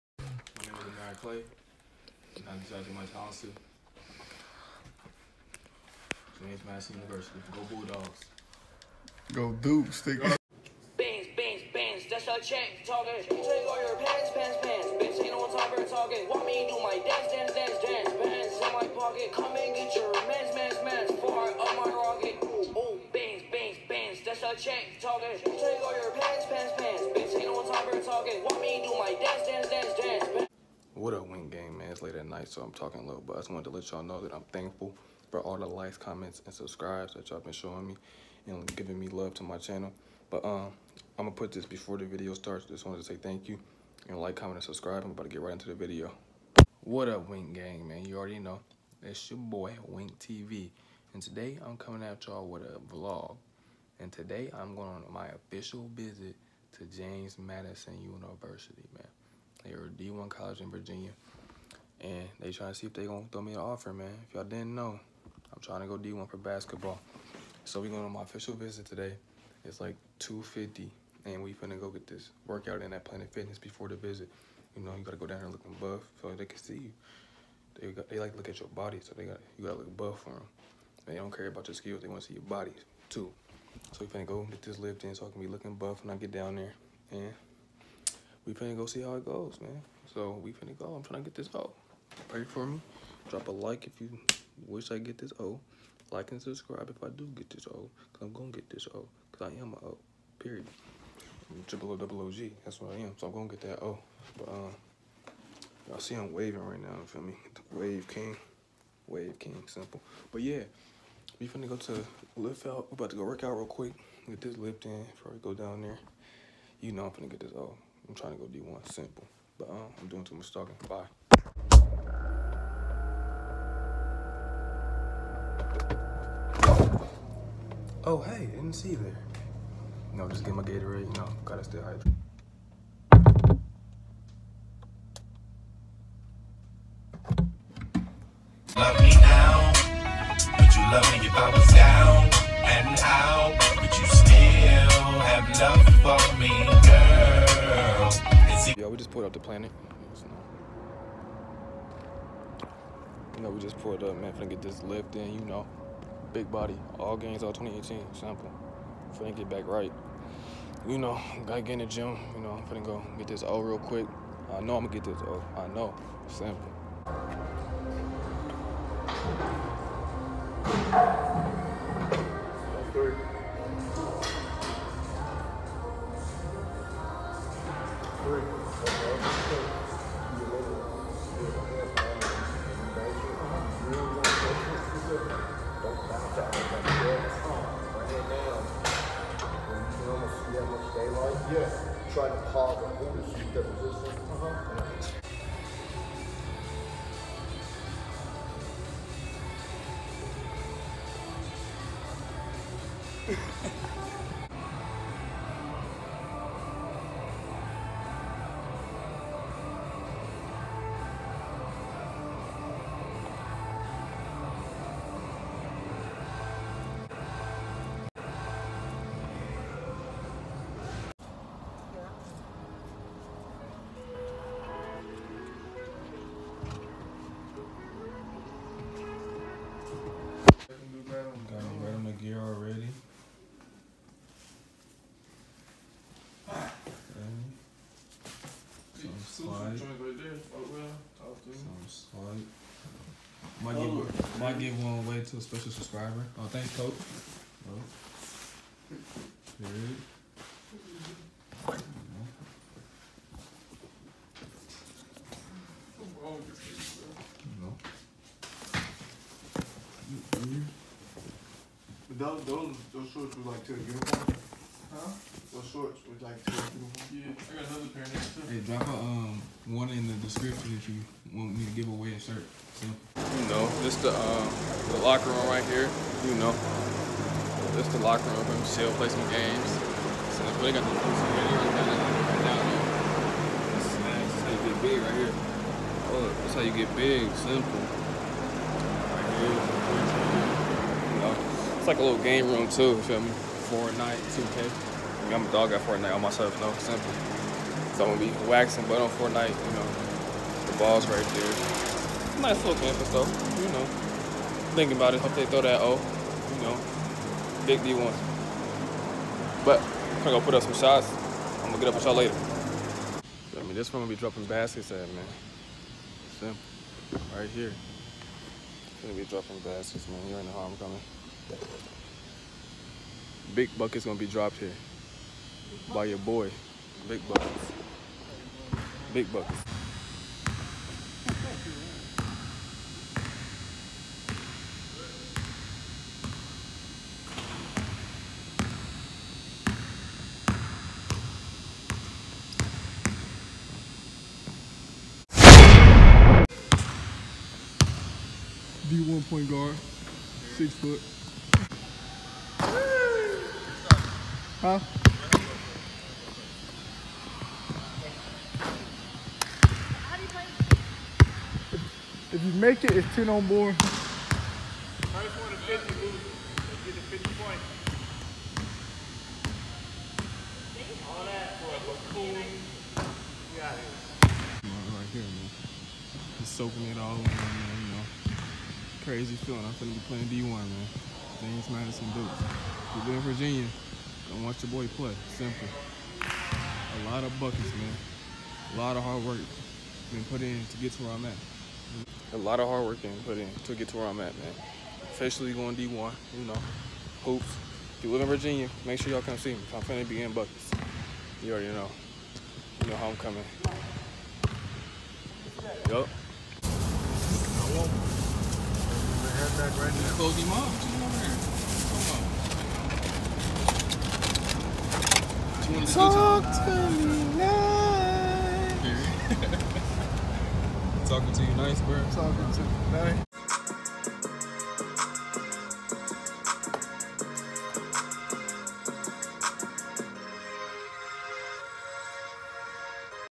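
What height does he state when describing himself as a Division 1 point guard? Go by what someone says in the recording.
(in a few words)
6 foot.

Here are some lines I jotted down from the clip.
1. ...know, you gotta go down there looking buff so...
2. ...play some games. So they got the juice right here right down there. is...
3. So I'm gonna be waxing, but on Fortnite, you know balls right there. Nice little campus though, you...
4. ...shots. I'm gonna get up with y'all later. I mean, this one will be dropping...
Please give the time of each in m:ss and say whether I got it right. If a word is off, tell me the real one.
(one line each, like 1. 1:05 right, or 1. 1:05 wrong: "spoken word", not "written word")
1. 1:14 right
2. 4:38 right
3. 4:57 right
4. 5:10 right.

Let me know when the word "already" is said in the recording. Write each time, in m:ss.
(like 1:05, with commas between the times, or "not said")
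0:48, 6:41.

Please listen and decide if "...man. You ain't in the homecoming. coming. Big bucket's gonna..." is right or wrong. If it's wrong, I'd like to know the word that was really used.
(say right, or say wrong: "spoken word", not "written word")
right.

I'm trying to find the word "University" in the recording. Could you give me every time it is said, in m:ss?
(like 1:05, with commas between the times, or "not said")
0:07, 0:58.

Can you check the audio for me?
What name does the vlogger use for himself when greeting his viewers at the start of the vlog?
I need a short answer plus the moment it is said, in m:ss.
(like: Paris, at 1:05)
Wink TV, at 0:49.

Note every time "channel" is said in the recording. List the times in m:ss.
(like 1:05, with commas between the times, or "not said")
0:39.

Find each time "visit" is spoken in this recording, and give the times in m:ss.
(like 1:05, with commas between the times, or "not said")
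0:55, 1:08, 1:13.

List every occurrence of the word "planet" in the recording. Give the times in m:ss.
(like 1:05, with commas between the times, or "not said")
1:13, 2:29.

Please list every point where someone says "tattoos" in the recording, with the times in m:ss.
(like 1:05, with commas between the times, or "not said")
not said.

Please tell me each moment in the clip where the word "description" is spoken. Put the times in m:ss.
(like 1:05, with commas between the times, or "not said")
4:30.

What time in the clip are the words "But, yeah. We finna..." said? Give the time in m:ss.
1:50.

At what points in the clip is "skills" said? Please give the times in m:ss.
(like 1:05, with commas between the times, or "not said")
1:21.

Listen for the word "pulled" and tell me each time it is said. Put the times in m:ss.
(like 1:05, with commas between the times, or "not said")
2:29, 2:33.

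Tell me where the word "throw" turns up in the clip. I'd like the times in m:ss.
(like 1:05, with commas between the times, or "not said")
1:03, 5:05.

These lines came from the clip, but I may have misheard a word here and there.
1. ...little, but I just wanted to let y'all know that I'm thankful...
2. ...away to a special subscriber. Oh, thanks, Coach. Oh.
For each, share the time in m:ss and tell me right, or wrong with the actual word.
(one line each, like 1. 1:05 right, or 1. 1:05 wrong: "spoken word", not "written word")
1. 0:33 right
2. 4:04 right.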